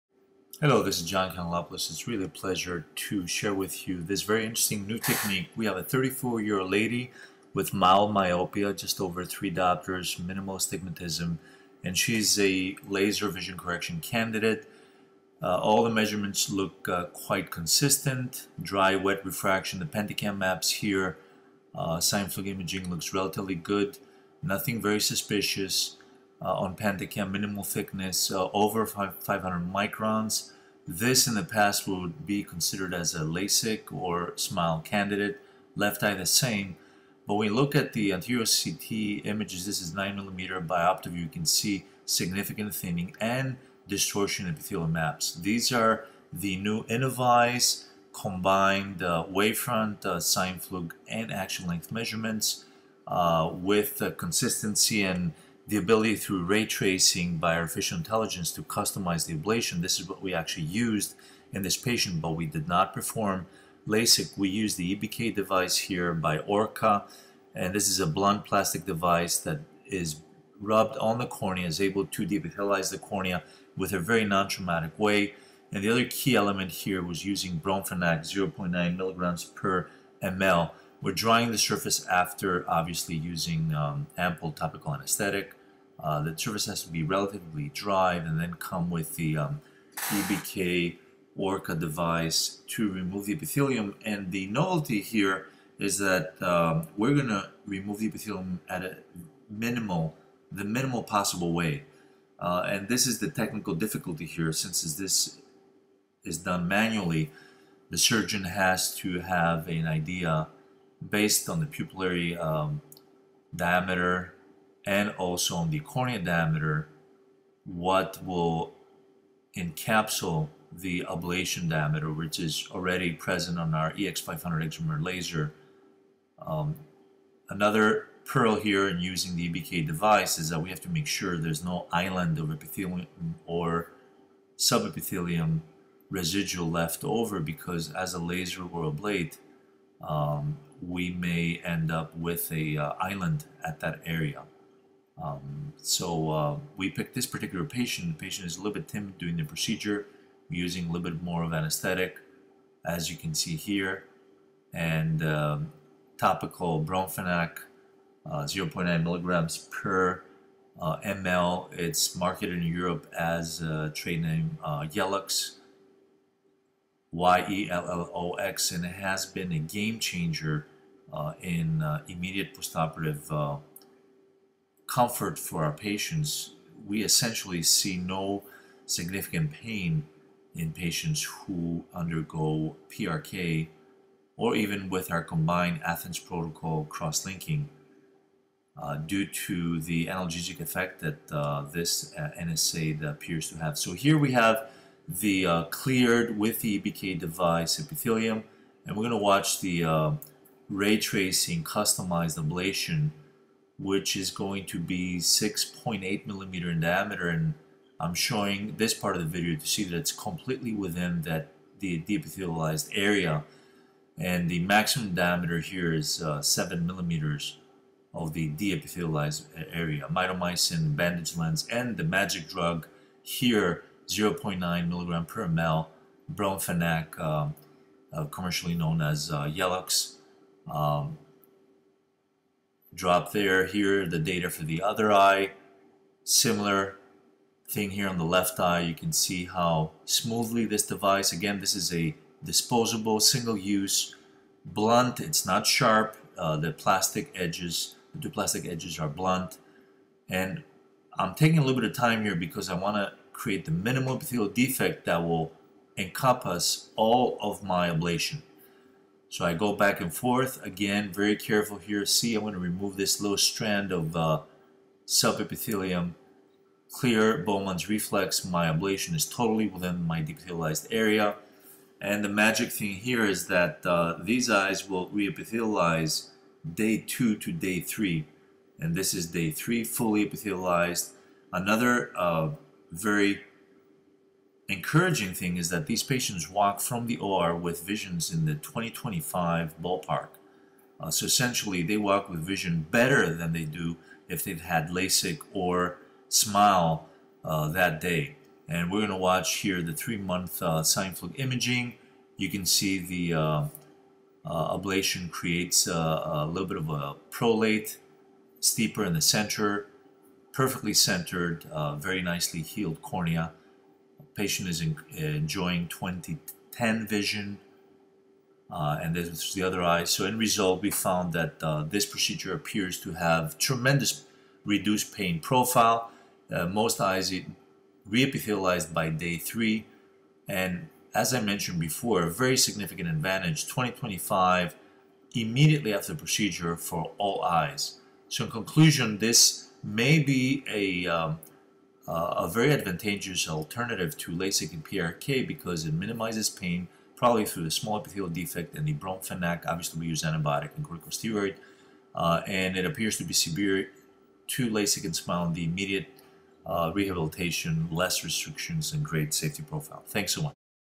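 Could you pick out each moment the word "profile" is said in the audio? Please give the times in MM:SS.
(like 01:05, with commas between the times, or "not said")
05:25, 05:59.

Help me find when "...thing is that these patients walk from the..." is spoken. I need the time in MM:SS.
04:45.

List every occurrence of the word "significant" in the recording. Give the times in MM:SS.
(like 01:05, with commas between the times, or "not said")
00:42, 02:58, 05:32.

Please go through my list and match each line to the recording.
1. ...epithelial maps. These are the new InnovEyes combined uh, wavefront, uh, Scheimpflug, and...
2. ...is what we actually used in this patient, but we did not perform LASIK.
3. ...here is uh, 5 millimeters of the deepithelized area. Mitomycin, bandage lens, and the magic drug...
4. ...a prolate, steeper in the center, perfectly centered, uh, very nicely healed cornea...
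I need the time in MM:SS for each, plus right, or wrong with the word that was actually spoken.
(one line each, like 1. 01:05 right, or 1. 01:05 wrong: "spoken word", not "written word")
1. 00:44 right
2. 00:59 right
3. 03:35 wrong: "7", not "5"
4. 05:06 right.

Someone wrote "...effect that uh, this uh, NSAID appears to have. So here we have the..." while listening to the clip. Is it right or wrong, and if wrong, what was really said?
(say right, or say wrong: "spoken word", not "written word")
right.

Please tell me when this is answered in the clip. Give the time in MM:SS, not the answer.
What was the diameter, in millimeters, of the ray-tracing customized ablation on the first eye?
03:25.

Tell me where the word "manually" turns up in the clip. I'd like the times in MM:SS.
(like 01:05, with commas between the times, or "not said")
01:46.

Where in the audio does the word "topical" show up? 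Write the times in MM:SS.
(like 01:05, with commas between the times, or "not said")
01:24, 02:36.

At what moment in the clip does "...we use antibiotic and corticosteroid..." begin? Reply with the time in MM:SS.
05:50.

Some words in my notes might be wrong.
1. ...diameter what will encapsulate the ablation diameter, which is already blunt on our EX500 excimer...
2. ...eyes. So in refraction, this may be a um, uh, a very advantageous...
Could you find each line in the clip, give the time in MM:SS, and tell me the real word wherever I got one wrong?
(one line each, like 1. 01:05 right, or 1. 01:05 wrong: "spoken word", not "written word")
1. 01:56 wrong: "present", not "blunt"
2. 05:37 wrong: "conclusion", not "refraction".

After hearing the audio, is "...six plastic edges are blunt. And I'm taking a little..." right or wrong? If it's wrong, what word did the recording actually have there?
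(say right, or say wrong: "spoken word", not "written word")
wrong: "two", not "six".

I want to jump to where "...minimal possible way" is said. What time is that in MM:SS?
01:40.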